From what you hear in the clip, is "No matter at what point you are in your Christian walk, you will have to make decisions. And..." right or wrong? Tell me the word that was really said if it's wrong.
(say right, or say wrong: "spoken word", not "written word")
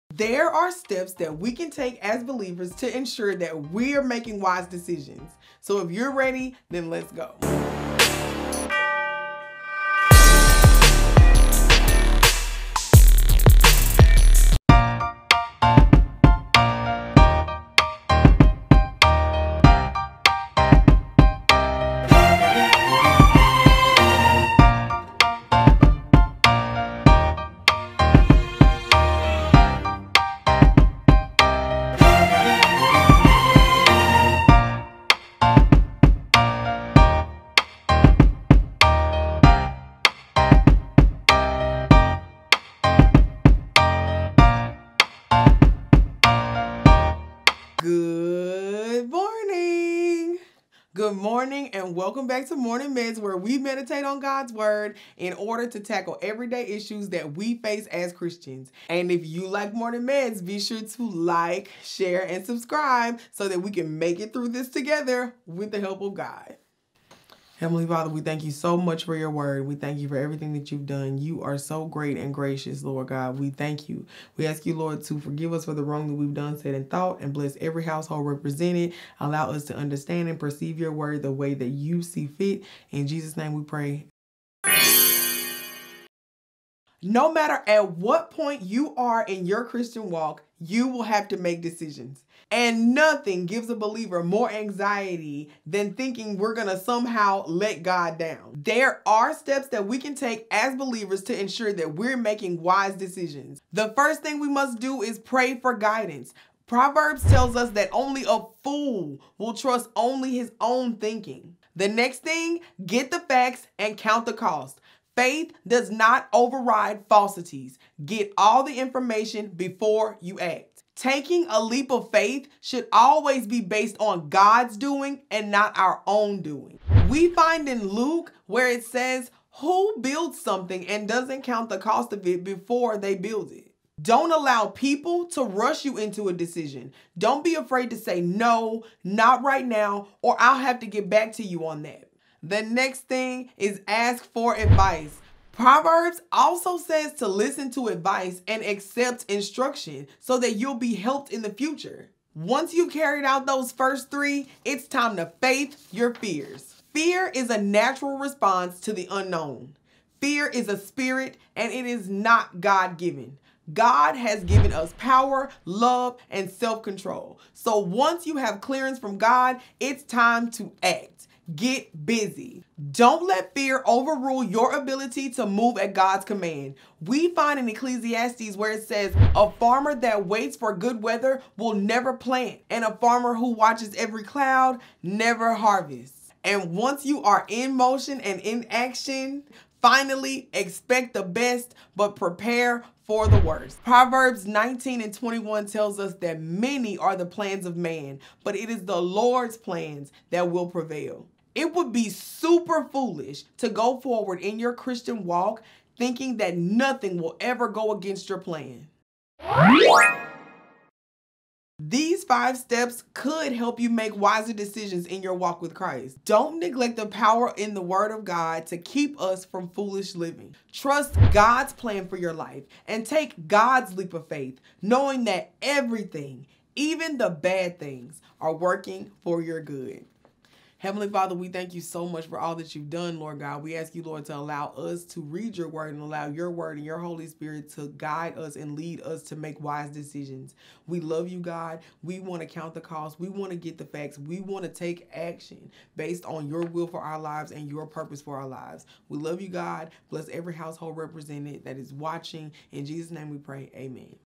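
right.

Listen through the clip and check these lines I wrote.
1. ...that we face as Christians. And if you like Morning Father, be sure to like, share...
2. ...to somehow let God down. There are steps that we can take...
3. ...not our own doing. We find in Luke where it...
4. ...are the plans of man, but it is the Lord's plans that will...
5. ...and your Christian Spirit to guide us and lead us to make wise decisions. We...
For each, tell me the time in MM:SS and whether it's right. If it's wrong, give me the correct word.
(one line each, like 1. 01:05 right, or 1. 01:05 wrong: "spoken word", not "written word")
1. 00:57 wrong: "Meds", not "Father"
2. 01:36 right
3. 02:05 right
4. 03:16 right
5. 03:56 wrong: "Holy", not "Christian".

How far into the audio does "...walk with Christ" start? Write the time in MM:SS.
03:35.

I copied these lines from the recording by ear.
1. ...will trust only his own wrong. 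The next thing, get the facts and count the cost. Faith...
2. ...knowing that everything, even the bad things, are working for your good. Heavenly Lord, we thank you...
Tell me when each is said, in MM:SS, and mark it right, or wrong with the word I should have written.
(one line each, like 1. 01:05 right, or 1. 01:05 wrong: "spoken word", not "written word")
1. 01:49 wrong: "thinking", not "wrong"
2. 03:44 wrong: "Father", not "Lord".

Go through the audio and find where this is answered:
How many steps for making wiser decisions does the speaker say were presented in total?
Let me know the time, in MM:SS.
03:32.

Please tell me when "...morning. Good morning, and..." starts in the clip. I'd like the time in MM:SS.
00:49.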